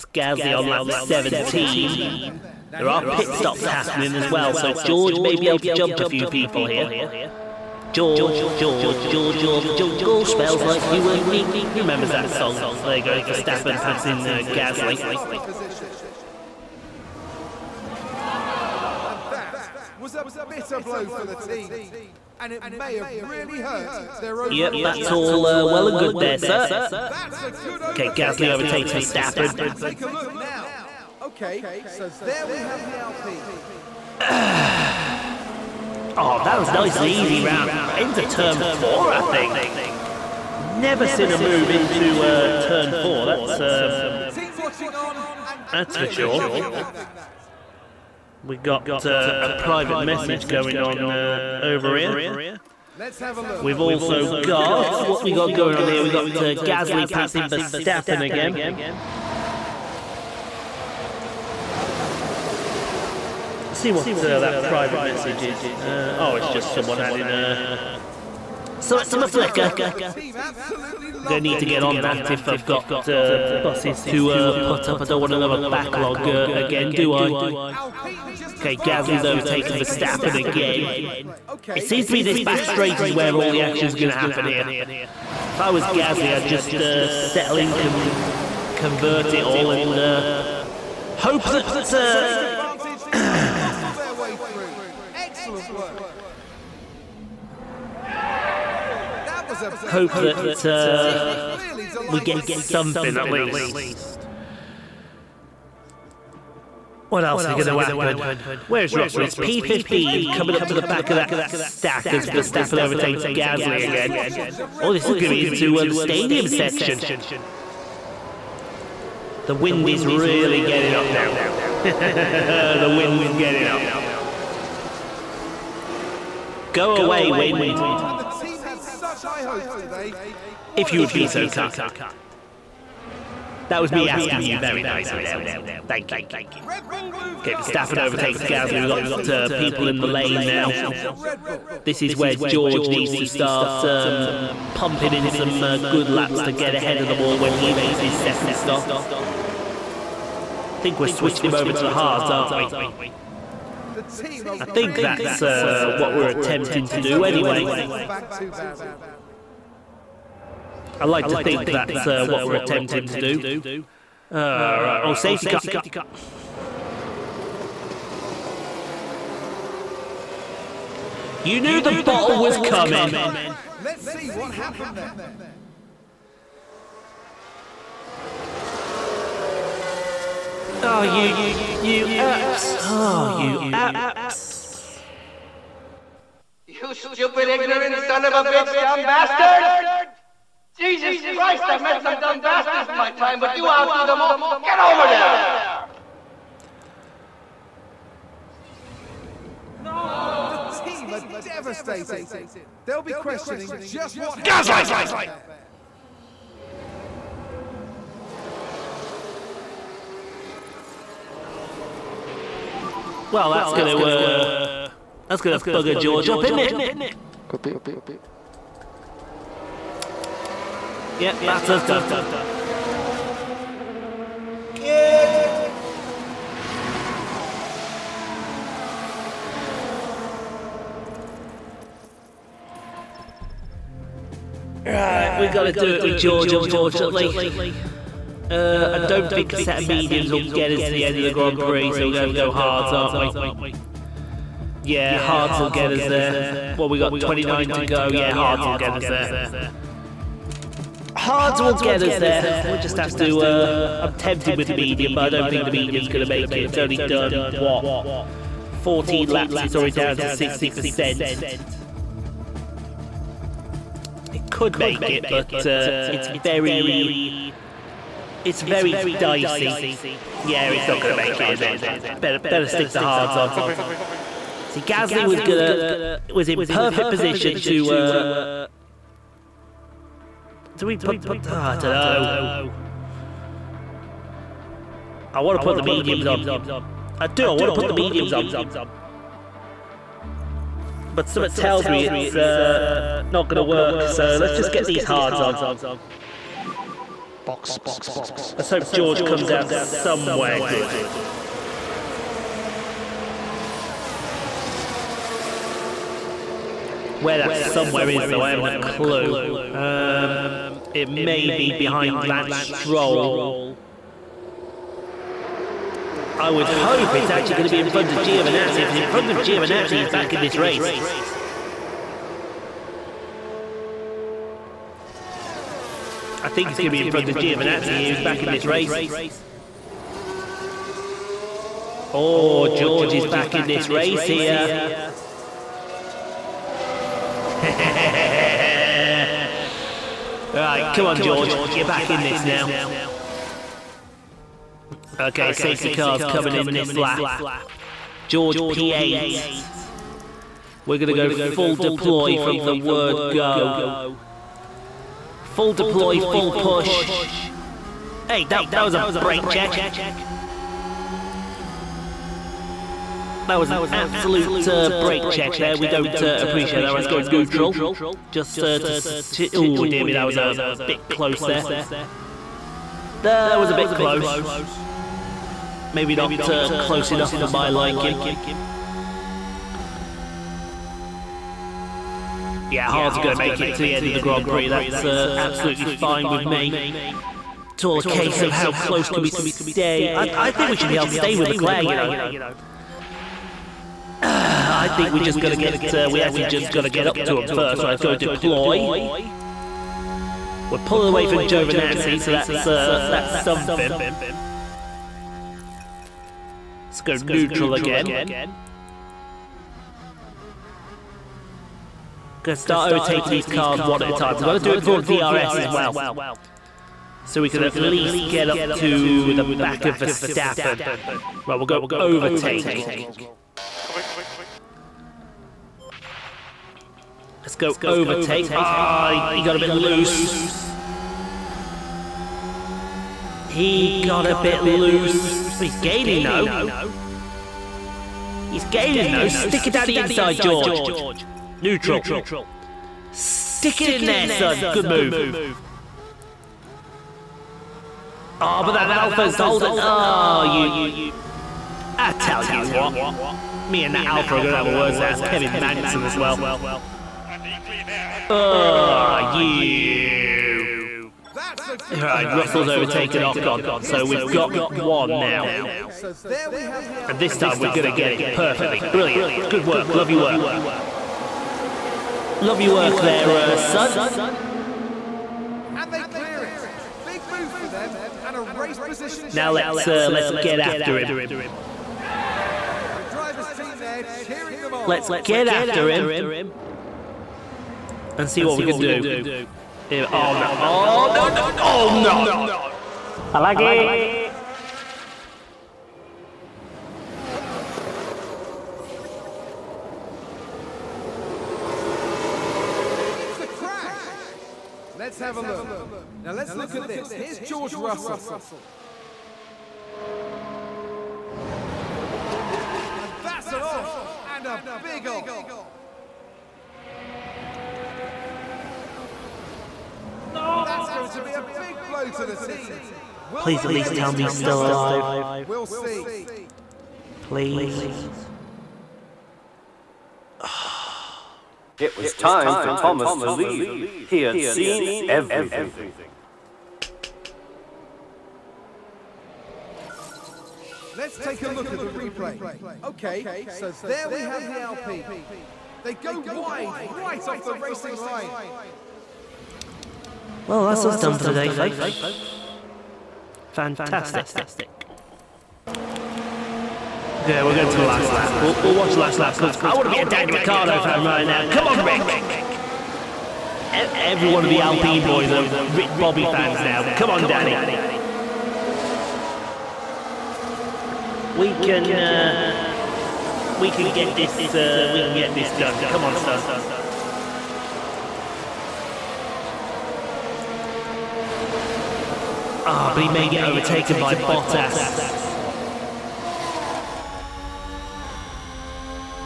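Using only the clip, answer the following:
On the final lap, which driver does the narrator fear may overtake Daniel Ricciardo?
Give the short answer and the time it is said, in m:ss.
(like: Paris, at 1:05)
Bottas, at 9:44.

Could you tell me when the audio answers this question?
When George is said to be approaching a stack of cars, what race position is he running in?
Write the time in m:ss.
1:49.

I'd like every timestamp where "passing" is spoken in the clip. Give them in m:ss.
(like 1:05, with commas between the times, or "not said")
0:13, 0:57.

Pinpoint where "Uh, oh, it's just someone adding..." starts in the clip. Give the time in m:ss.
1:05.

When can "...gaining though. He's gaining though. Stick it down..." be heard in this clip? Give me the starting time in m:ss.
7:15.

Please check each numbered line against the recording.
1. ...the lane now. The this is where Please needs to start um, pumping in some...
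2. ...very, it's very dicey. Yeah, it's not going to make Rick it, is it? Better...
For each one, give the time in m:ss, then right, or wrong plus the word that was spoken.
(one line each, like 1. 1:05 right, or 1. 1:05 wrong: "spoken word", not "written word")
1. 2:20 wrong: "George", not "Please"
2. 4:26 wrong: "Charge", not "Rick".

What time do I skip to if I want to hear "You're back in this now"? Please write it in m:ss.
5:41.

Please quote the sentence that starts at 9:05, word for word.
They go wide, right off the racing line.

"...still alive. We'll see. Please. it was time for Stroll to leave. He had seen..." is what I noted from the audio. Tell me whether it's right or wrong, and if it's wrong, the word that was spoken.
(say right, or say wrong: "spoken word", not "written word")
wrong: "Thomas", not "Stroll".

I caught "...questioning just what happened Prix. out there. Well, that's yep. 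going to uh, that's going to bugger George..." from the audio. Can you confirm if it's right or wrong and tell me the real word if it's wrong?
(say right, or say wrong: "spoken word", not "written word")
wrong: "Gaslight", not "Prix".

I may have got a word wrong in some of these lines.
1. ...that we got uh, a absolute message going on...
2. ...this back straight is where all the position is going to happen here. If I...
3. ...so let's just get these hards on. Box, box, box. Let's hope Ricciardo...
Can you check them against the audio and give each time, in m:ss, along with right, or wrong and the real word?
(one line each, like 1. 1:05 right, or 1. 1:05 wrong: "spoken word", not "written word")
1. 0:46 wrong: "private", not "absolute"
2. 1:22 wrong: "action", not "position"
3. 4:54 wrong: "George", not "Ricciardo".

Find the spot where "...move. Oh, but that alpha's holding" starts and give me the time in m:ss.
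7:24.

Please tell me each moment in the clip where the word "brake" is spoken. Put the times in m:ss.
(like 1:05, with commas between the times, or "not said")
5:59, 6:04.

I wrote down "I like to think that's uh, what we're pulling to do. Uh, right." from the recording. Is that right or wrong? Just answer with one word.
wrong.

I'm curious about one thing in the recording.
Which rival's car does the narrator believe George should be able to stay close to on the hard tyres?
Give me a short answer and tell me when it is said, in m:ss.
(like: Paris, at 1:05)
Leclerc, at 6:31.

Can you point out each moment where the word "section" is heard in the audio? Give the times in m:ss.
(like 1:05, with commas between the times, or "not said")
1:56.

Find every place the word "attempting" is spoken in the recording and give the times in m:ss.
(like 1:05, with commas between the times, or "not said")
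2:36, 2:42.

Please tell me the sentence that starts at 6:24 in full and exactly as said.
That's uh, absolutely fine with me.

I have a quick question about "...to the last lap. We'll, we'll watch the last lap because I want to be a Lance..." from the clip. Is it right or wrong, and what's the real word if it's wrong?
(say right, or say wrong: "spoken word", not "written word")
wrong: "Daniel", not "Lance".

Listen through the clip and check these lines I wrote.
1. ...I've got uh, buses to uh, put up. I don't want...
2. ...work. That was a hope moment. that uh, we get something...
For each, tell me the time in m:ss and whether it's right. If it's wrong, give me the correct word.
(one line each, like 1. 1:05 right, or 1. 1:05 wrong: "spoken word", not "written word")
1. 1:12 right
2. 1:35 right.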